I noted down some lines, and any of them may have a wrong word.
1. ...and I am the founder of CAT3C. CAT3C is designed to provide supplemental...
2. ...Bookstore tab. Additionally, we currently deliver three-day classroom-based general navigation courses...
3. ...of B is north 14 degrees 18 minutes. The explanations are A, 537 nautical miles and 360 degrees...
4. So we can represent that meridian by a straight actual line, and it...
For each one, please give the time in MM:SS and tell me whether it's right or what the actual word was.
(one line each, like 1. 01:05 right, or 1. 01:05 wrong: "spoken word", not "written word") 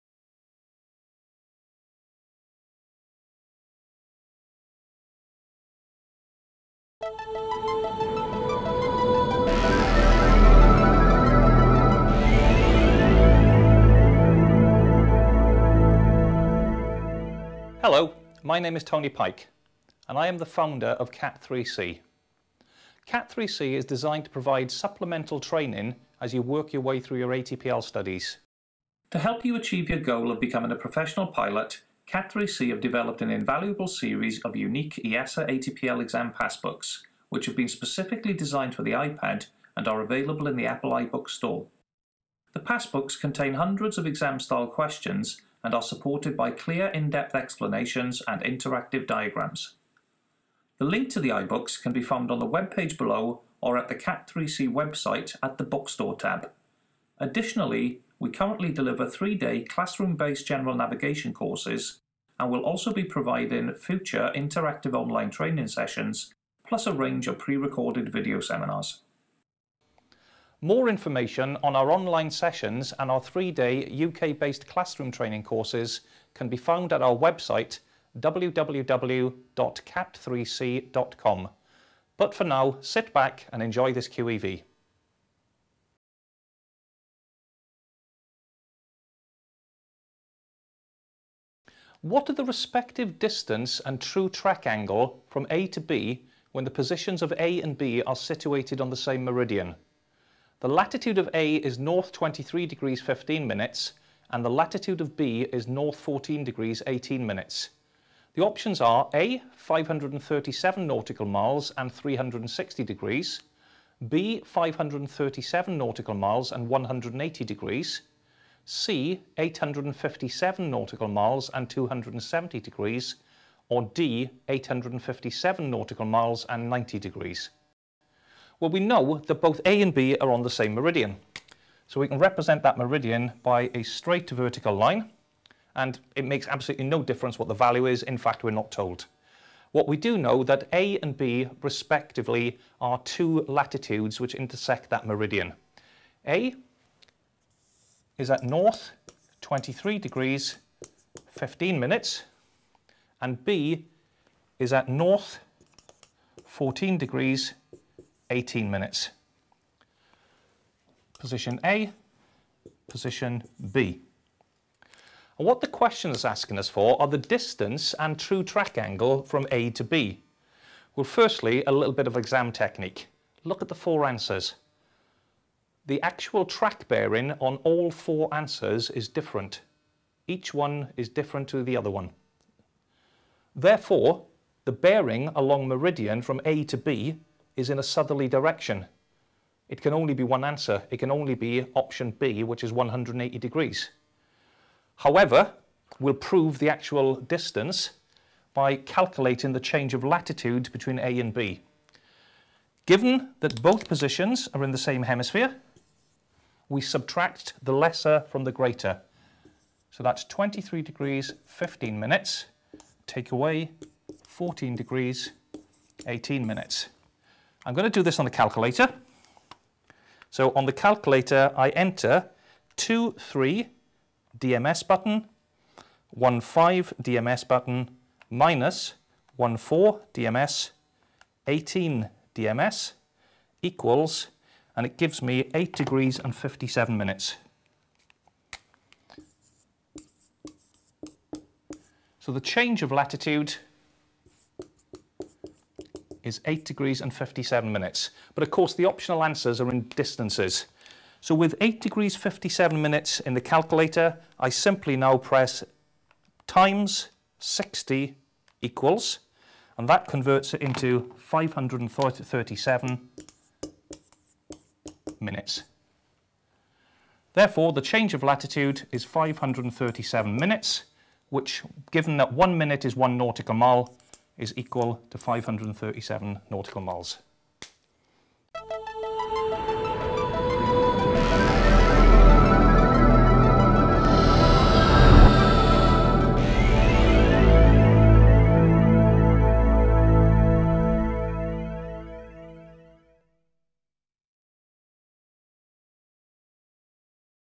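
1. 00:20 right
2. 00:55 right
3. 01:44 wrong: "options", not "explanations"
4. 02:11 wrong: "vertical", not "actual".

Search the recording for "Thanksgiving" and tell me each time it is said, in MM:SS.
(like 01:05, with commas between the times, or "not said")
not said.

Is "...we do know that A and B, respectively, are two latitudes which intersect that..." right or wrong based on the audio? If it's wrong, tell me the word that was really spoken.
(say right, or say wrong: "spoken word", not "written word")
right.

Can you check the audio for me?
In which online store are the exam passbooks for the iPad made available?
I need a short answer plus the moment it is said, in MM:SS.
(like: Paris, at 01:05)
Apple iBook Store, at 00:40.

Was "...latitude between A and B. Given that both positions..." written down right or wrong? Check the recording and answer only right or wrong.
right.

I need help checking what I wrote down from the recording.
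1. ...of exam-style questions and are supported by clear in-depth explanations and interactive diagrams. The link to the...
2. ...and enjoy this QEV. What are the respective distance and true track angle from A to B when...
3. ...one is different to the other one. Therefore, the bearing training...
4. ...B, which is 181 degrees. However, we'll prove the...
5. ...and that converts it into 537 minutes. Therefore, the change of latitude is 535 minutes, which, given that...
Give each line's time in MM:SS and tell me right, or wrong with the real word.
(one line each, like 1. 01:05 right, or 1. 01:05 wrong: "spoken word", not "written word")
1. 00:43 right
2. 01:23 right
3. 03:00 wrong: "along", not "training"
4. 03:12 wrong: "180", not "181"
5. 04:19 wrong: "537", not "535".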